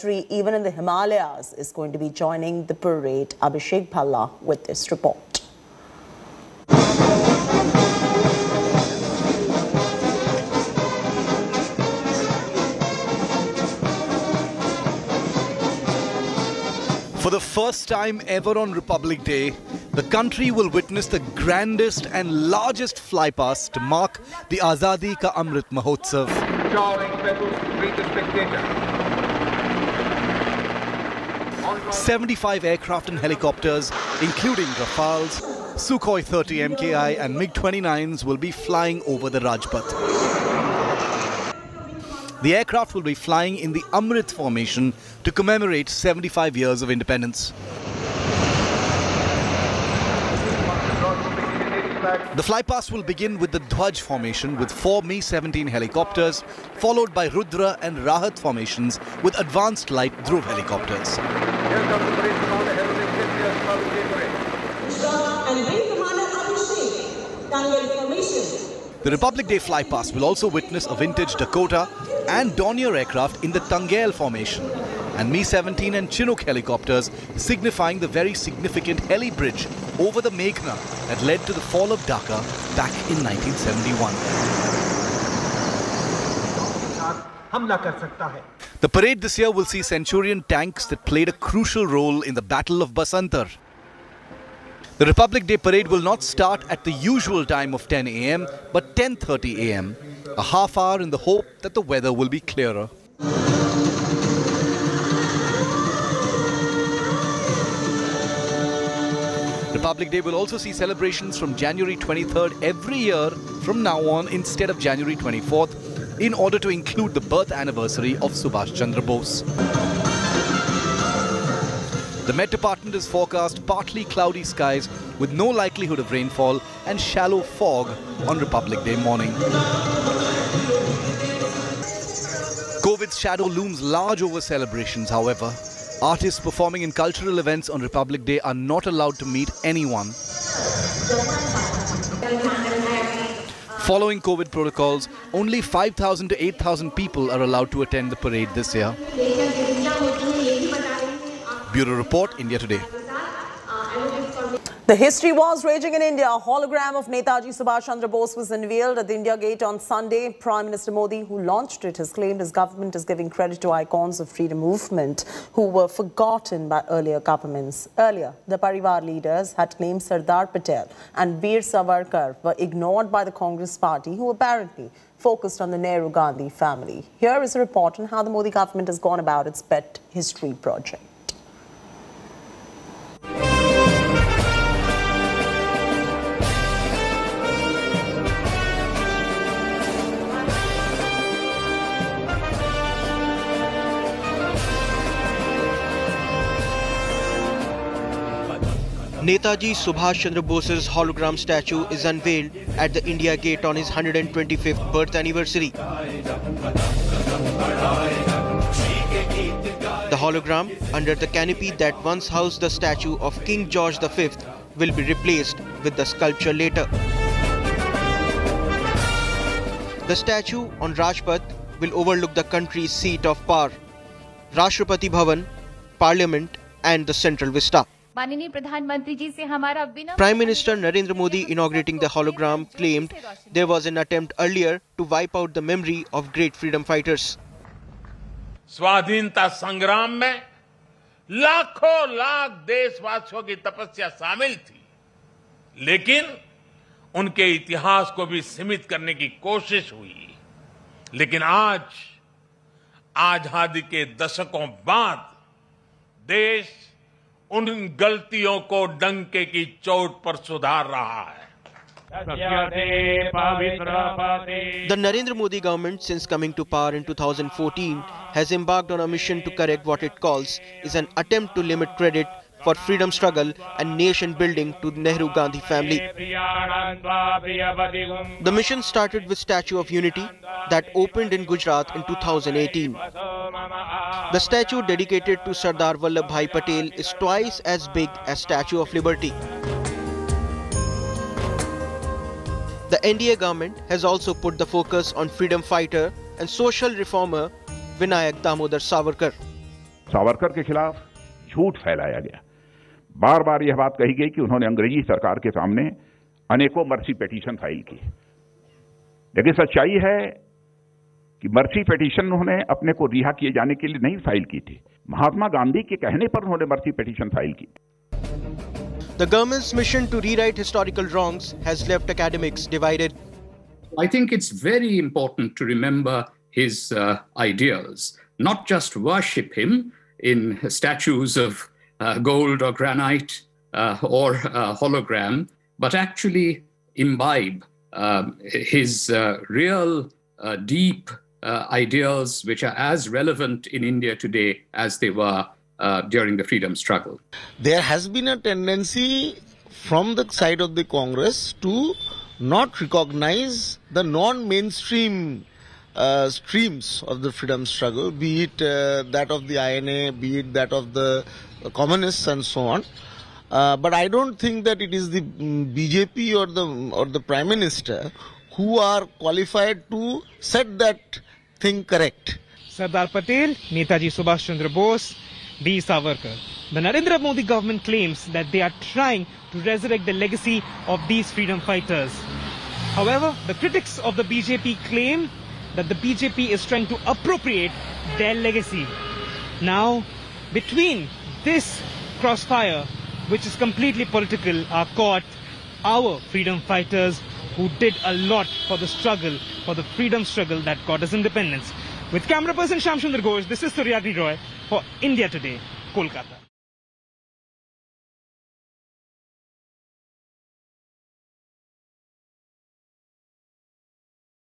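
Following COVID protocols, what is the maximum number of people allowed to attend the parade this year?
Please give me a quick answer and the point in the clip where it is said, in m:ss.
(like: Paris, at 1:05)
8,000, at 2:26.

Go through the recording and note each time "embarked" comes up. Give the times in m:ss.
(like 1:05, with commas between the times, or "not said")
4:28.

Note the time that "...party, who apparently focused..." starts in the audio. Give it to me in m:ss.
2:53.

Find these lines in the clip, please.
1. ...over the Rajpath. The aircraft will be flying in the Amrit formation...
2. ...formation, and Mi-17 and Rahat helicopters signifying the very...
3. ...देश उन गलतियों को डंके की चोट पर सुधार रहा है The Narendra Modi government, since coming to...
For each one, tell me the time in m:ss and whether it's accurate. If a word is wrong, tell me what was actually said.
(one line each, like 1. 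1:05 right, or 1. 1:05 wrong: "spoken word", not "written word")
1. 0:39 right
2. 1:14 wrong: "Chinook", not "Rahat"
3. 4:16 right.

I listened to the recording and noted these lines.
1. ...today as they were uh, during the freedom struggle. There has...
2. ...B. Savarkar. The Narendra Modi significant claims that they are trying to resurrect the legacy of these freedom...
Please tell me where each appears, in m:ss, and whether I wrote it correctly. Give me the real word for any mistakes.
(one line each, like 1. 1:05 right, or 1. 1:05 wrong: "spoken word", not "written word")
1. 5:44 right
2. 6:15 wrong: "government", not "significant".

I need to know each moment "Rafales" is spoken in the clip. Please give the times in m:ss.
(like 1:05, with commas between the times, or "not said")
0:34.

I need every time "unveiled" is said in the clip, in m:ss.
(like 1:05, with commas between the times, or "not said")
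2:38, 3:22.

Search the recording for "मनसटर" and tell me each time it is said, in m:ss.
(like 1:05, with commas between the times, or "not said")
3:50.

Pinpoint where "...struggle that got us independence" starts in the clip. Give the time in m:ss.
6:40.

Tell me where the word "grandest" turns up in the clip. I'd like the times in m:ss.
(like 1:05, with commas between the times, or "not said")
0:21.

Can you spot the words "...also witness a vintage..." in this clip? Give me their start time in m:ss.
1:10.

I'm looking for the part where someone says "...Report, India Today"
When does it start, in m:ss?
2:31.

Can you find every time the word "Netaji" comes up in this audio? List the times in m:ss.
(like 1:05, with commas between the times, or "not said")
2:37, 3:19, 6:13.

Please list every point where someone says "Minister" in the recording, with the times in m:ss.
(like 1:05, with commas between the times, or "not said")
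2:40, 6:07.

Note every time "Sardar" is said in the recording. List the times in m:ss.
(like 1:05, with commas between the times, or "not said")
2:50, 4:45, 6:12.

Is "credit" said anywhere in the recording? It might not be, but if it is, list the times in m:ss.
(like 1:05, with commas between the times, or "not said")
2:43, 4:31.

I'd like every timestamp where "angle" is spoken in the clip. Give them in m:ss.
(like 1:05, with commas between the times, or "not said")
not said.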